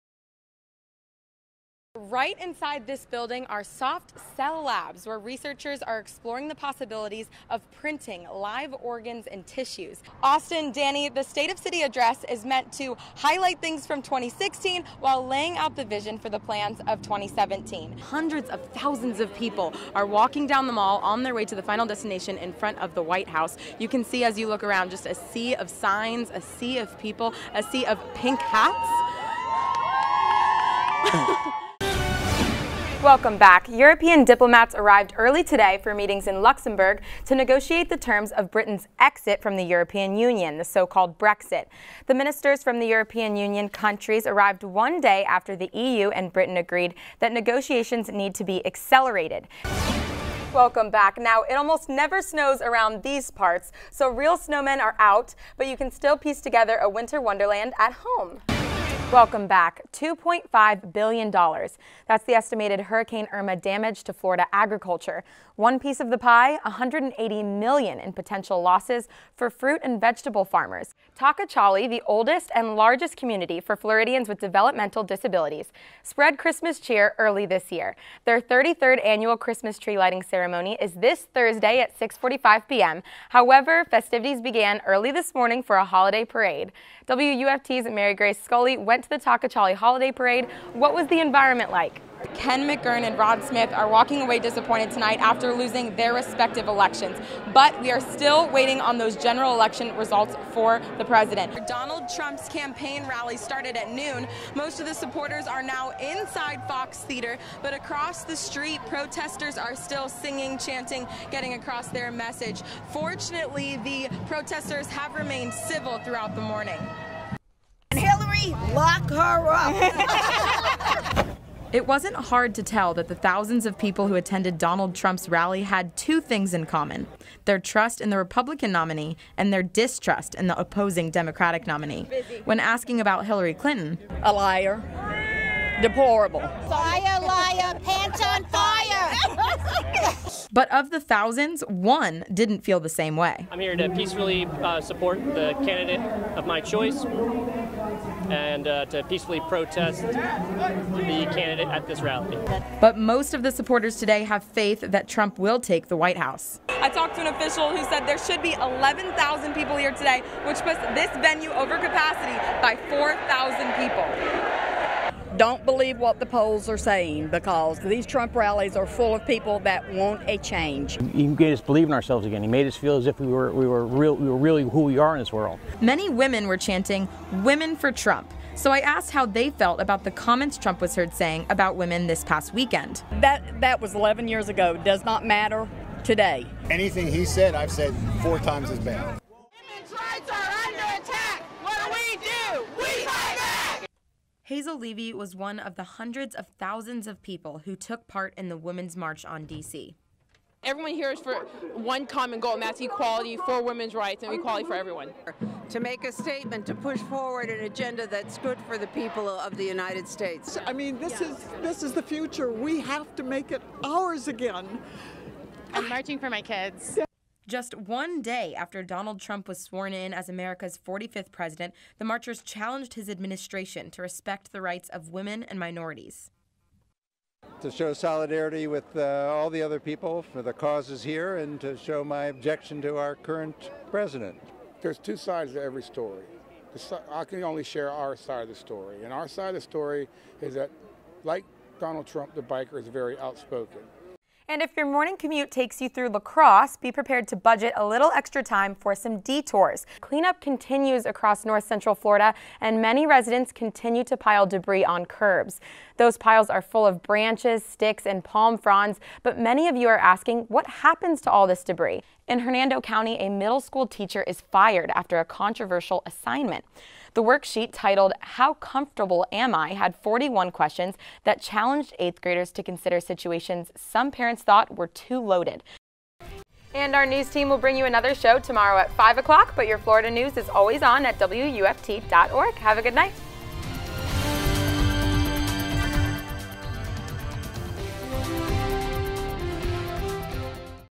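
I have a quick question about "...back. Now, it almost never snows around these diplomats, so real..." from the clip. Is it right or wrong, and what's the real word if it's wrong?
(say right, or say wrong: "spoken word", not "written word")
wrong: "parts", not "diplomats".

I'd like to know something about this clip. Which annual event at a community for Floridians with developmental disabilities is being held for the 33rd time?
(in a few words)
Christmas tree lighting ceremony.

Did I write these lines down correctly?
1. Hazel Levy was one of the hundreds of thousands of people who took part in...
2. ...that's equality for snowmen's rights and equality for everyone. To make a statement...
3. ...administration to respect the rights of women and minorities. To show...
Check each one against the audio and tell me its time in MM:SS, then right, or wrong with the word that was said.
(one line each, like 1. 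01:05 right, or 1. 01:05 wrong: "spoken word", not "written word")
1. 03:14 right
2. 03:22 wrong: "women", not "snowmen"
3. 03:43 right.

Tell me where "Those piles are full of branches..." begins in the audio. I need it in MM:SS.
04:15.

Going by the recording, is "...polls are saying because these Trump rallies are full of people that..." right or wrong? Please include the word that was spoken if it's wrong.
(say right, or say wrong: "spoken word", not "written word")
right.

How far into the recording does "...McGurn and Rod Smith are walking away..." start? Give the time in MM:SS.
01:32.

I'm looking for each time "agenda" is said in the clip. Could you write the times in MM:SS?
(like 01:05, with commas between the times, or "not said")
03:27.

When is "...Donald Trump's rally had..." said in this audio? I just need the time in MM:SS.
02:04.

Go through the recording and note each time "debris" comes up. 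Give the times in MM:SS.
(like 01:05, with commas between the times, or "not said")
04:14, 04:21.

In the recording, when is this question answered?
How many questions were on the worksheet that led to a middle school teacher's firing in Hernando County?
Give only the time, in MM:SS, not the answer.
04:29.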